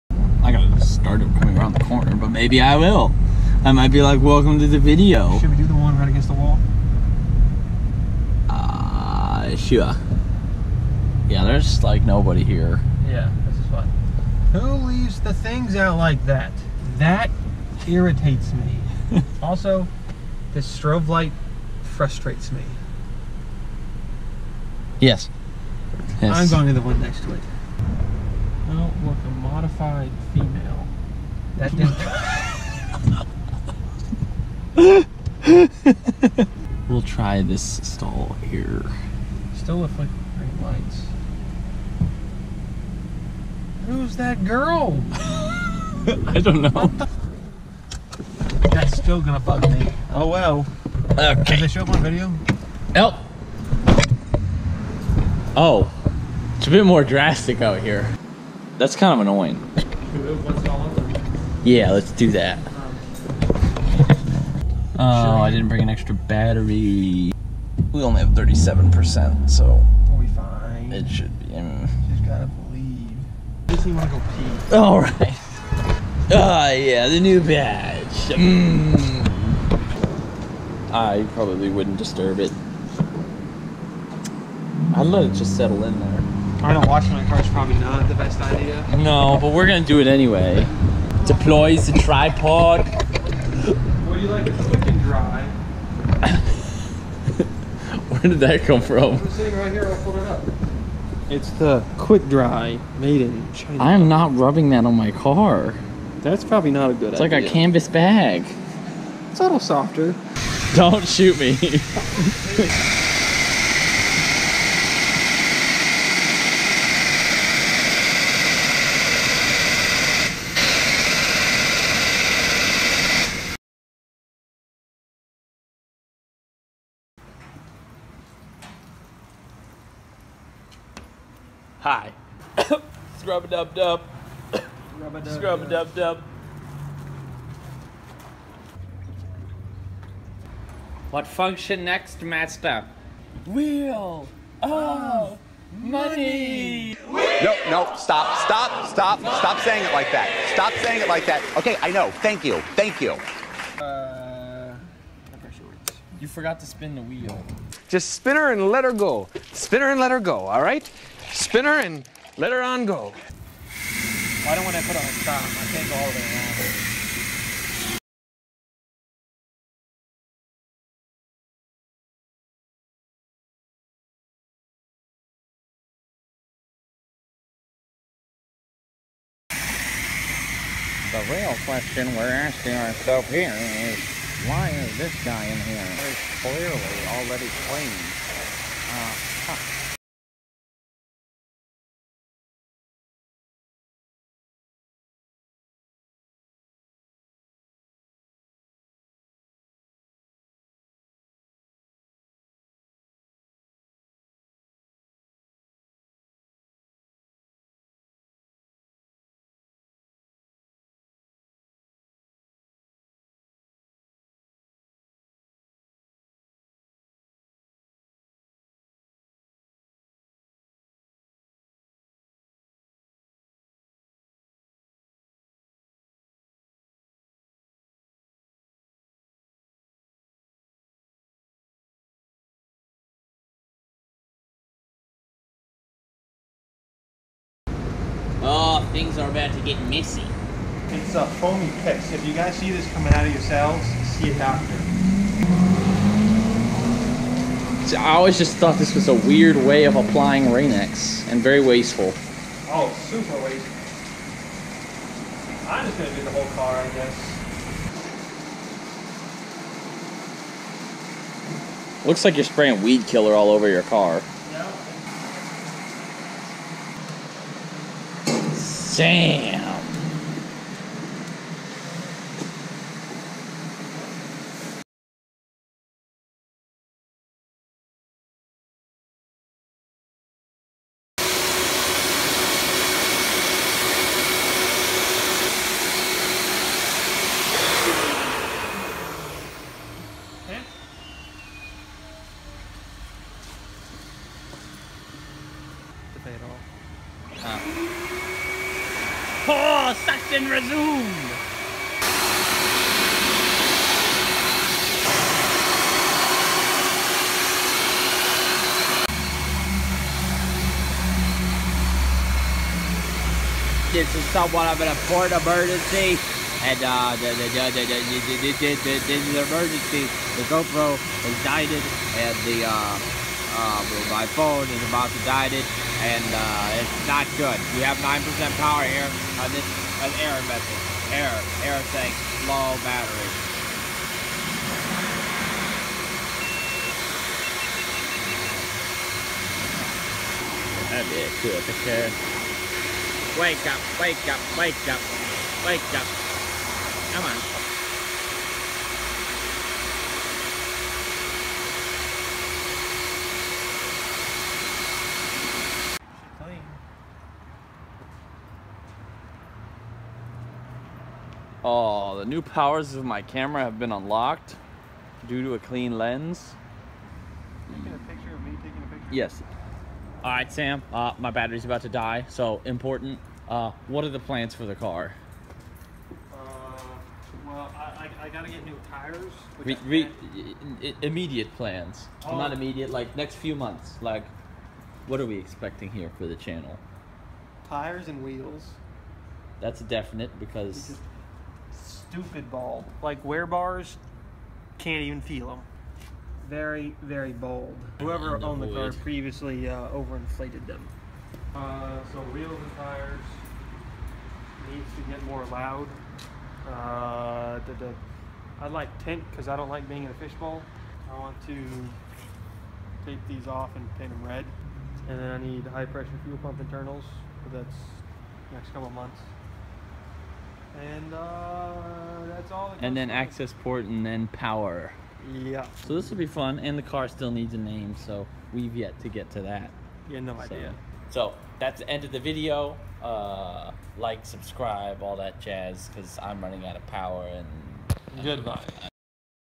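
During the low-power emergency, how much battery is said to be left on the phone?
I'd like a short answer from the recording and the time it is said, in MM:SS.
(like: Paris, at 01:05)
9%, at 05:28.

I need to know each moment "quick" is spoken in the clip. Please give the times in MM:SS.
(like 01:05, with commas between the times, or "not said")
01:34, 01:41.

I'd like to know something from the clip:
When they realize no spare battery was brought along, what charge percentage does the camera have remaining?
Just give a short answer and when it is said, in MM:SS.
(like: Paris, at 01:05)
37%, at 01:08.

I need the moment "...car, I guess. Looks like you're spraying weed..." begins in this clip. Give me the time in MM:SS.
04:16.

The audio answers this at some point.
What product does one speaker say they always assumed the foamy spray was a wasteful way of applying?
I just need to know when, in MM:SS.
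04:10.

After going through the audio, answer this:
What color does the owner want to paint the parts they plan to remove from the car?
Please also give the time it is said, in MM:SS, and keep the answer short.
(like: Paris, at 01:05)
Red, at 06:54.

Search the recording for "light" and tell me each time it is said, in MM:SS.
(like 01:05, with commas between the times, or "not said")
00:21, 00:40.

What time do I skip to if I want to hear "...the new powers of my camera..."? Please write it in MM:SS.
06:02.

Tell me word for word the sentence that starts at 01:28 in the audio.
No, but we're gonna do it anyway.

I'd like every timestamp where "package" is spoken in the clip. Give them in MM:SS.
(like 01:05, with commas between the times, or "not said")
not said.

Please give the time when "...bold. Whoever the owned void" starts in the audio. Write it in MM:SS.
06:37.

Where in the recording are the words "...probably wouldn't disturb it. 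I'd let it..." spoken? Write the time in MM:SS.
01:21.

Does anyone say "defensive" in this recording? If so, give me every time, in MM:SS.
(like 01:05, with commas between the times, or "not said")
not said.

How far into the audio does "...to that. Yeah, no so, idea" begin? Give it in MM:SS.
07:09.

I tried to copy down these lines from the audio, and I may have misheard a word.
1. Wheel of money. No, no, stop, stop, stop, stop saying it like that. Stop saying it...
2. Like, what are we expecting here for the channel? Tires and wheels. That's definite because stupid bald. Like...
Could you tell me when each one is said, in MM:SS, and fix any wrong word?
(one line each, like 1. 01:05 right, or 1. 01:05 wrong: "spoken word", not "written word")
1. 02:23 right
2. 06:24 right.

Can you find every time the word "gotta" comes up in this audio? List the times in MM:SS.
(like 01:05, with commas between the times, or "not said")
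01:12, 06:18.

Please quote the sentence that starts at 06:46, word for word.
Uh, I like tint because I don't like being in a fishbowl.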